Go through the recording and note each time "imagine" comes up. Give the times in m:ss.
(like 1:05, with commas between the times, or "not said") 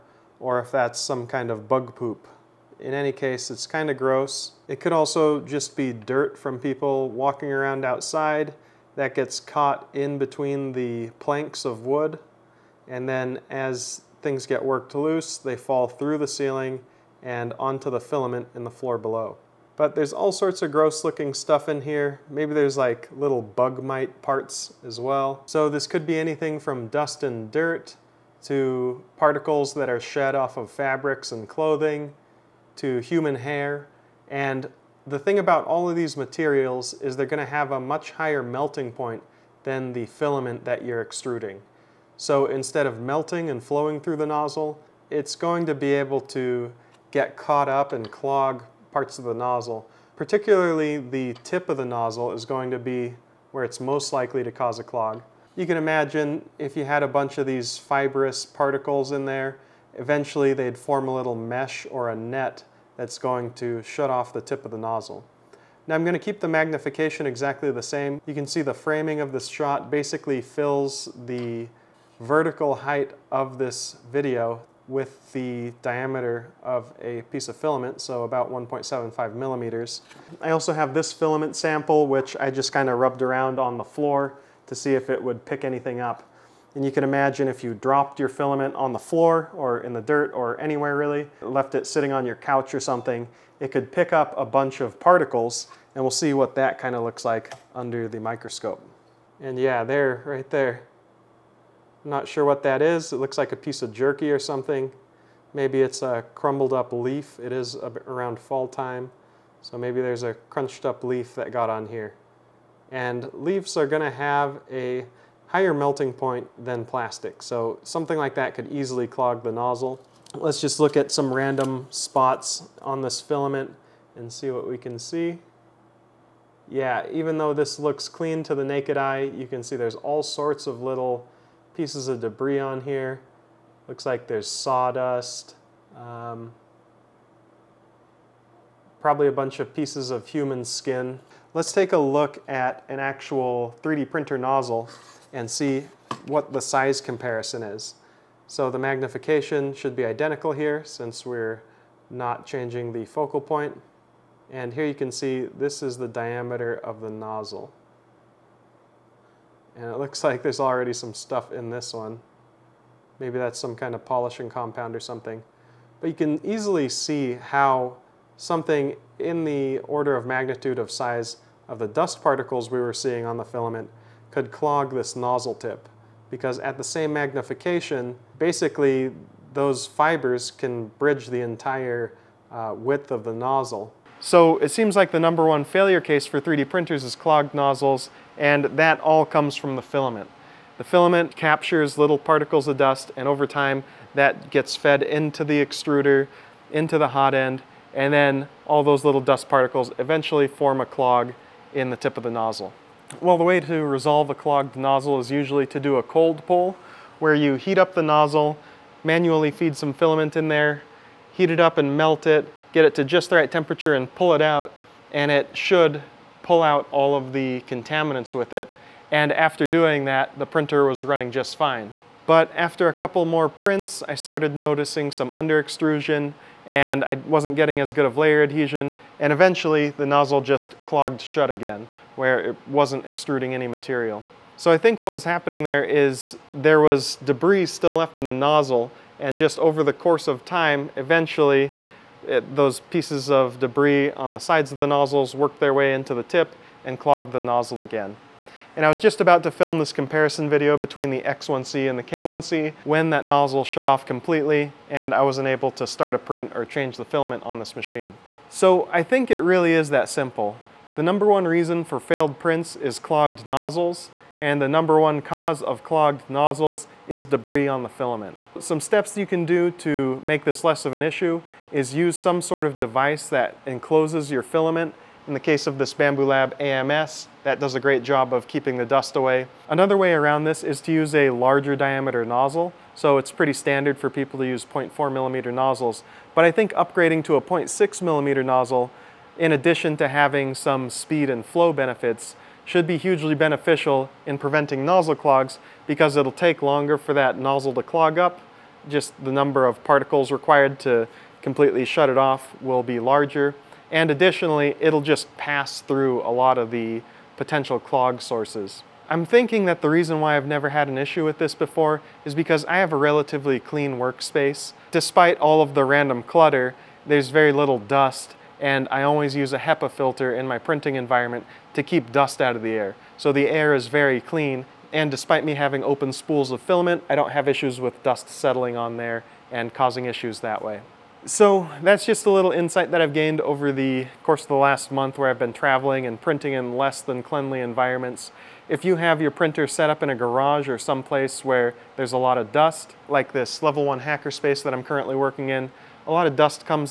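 0:55, 1:27.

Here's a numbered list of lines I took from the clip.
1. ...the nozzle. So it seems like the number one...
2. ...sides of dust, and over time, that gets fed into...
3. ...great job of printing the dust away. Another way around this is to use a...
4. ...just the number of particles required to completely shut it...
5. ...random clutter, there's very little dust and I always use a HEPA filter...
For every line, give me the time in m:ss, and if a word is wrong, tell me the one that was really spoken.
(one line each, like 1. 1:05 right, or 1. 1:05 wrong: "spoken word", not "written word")
1. 3:03 right
2. 3:12 wrong: "particles", not "sides"
3. 4:37 wrong: "keeping", not "printing"
4. 4:58 right
5. 5:15 right.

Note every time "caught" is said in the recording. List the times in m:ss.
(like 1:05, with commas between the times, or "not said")
0:09, 0:47.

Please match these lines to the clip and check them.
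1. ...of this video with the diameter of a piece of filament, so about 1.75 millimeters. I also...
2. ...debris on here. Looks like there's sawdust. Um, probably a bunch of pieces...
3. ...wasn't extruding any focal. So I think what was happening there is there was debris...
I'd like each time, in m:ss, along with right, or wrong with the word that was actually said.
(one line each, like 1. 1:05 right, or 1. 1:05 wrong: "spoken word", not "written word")
1. 1:13 right
2. 2:12 right
3. 3:52 wrong: "material", not "focal".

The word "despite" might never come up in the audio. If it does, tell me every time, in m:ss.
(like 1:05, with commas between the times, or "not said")
5:14, 5:25.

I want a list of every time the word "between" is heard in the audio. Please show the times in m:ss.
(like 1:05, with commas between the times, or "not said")
0:10, 4:10.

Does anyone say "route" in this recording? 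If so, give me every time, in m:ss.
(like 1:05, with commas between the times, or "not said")
not said.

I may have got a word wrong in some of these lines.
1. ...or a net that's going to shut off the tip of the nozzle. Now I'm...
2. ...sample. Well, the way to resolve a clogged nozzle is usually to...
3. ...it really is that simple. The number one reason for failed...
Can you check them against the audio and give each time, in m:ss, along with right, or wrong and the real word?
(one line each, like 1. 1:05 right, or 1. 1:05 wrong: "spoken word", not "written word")
1. 1:01 right
2. 3:22 wrong: "nozzle", not "sample"
3. 4:19 right.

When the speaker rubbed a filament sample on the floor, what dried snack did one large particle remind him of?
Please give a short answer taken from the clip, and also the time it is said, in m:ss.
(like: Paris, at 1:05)
jerky, at 1:43.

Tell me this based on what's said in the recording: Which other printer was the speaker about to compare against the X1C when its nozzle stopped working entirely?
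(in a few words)
K1C.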